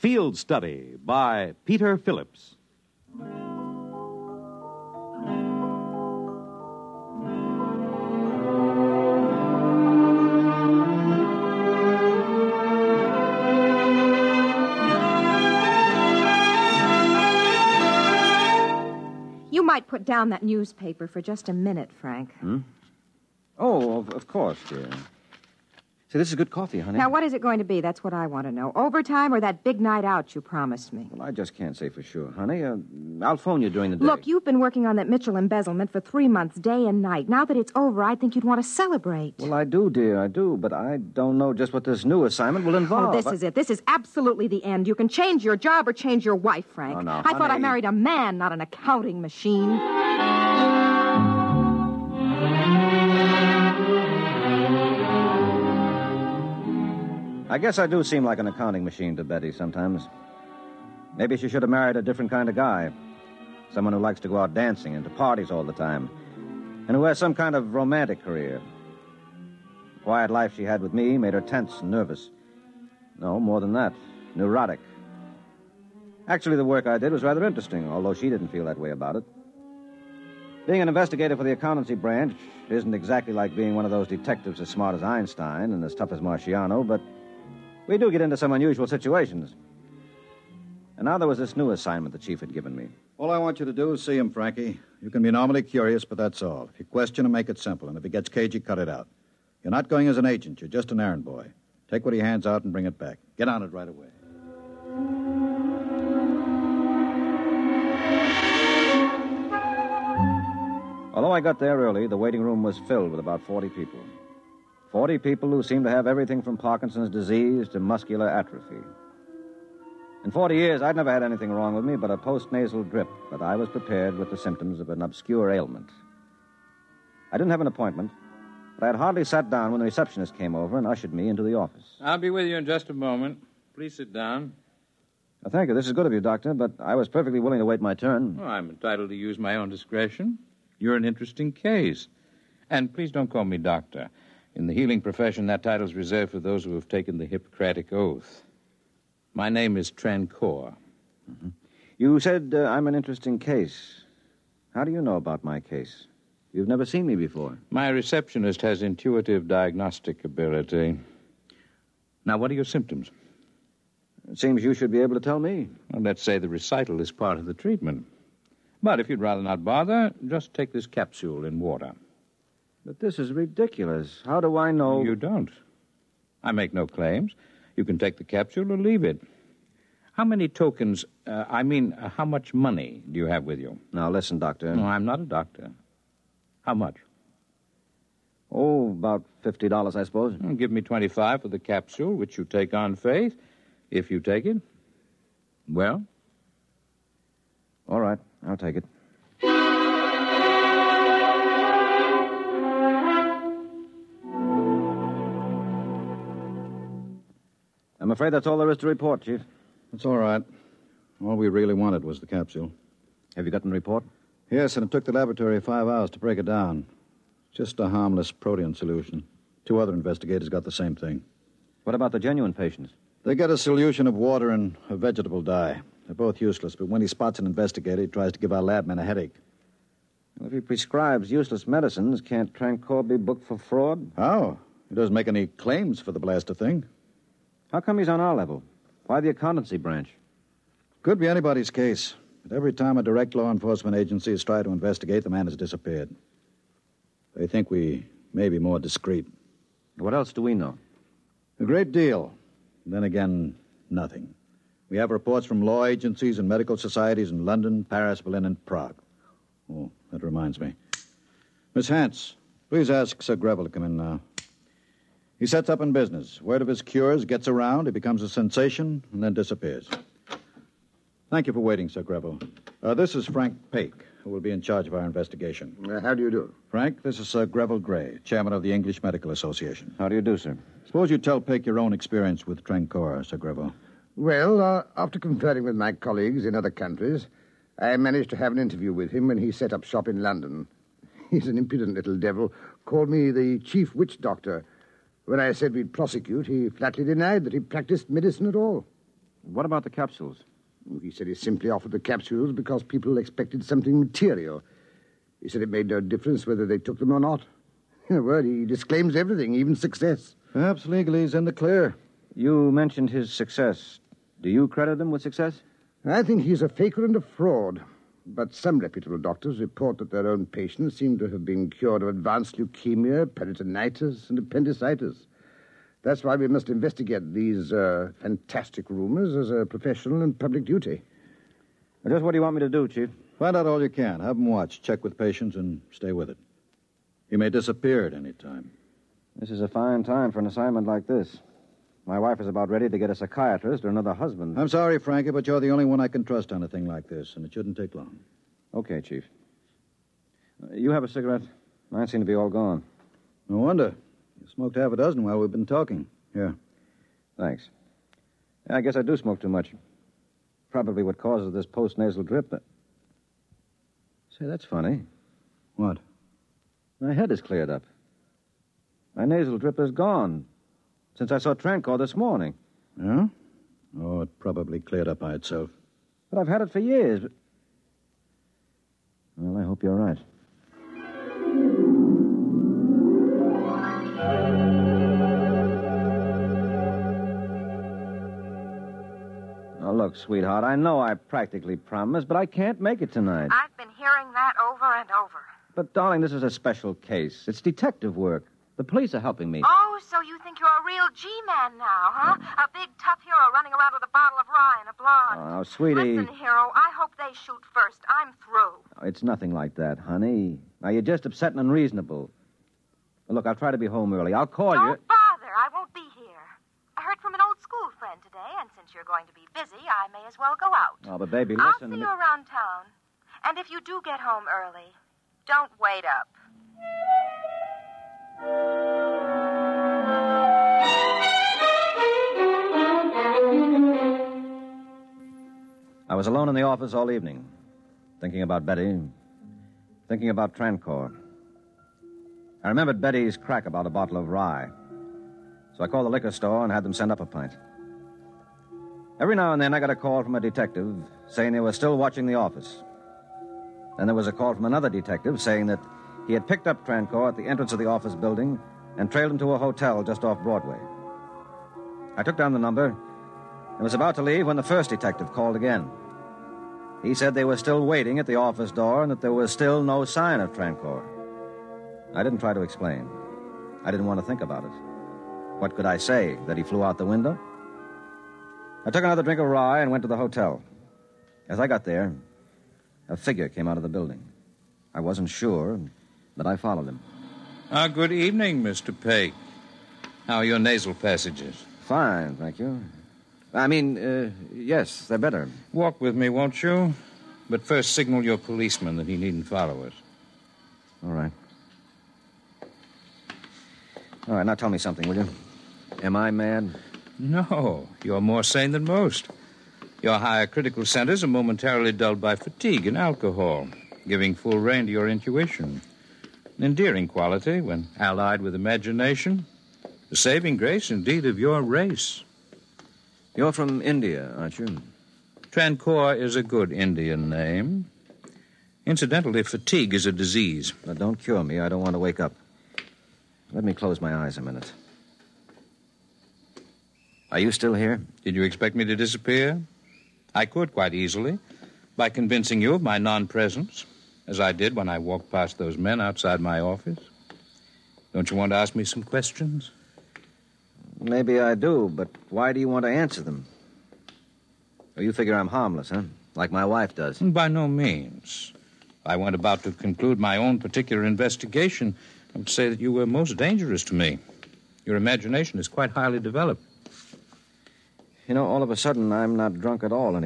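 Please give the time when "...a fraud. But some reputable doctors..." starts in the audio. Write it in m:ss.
5:17.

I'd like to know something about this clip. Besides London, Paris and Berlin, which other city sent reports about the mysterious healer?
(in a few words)
Prague.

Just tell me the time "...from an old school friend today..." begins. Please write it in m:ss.
6:57.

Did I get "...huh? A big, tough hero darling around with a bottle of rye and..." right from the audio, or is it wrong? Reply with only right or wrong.
wrong.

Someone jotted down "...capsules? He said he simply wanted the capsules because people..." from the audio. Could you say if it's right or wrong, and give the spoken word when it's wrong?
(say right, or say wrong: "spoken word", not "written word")
wrong: "offered", not "wanted".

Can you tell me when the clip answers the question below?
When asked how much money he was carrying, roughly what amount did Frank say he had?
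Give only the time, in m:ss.
3:08.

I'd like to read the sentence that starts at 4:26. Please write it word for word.
Word of his cures gets around, he becomes a sensation, and then disappears.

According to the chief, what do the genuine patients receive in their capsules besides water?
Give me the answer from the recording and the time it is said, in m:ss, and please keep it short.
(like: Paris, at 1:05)
Vegetable dye, at 3:44.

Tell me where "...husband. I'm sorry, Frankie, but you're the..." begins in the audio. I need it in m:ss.
5:44.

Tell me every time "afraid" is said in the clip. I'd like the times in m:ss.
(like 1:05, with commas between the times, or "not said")
3:28.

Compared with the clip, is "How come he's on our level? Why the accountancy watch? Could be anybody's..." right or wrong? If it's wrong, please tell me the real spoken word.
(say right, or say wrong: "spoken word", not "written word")
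wrong: "branch", not "watch".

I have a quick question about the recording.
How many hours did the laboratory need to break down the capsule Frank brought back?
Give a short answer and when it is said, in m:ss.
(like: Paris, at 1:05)
5, at 3:35.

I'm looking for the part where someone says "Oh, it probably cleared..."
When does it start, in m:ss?
6:14.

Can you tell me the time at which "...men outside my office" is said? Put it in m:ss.
9:05.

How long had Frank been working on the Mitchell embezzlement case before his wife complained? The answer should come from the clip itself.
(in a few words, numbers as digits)
3 months.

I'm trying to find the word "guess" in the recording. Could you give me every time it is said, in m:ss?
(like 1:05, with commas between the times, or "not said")
0:57, 5:58.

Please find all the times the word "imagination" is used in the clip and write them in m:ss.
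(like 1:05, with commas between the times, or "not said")
8:38, 9:24.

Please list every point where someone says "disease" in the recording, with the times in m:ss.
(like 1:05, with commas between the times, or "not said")
1:57, 8:50.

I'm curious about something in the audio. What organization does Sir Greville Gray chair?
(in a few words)
English Medical Association.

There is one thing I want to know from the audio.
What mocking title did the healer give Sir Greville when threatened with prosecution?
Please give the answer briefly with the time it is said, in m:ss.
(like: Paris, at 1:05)
Chief witch doctor, at 4:53.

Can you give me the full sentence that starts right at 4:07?
They think we may be more discreet.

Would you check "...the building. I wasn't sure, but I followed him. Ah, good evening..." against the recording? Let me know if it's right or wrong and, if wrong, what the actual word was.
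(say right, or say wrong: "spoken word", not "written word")
right.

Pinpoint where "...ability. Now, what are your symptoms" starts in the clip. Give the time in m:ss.
2:40.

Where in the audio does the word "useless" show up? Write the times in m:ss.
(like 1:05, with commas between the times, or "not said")
3:46, 3:51.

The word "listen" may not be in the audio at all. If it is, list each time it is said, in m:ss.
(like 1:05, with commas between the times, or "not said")
3:04, 6:46, 7:01.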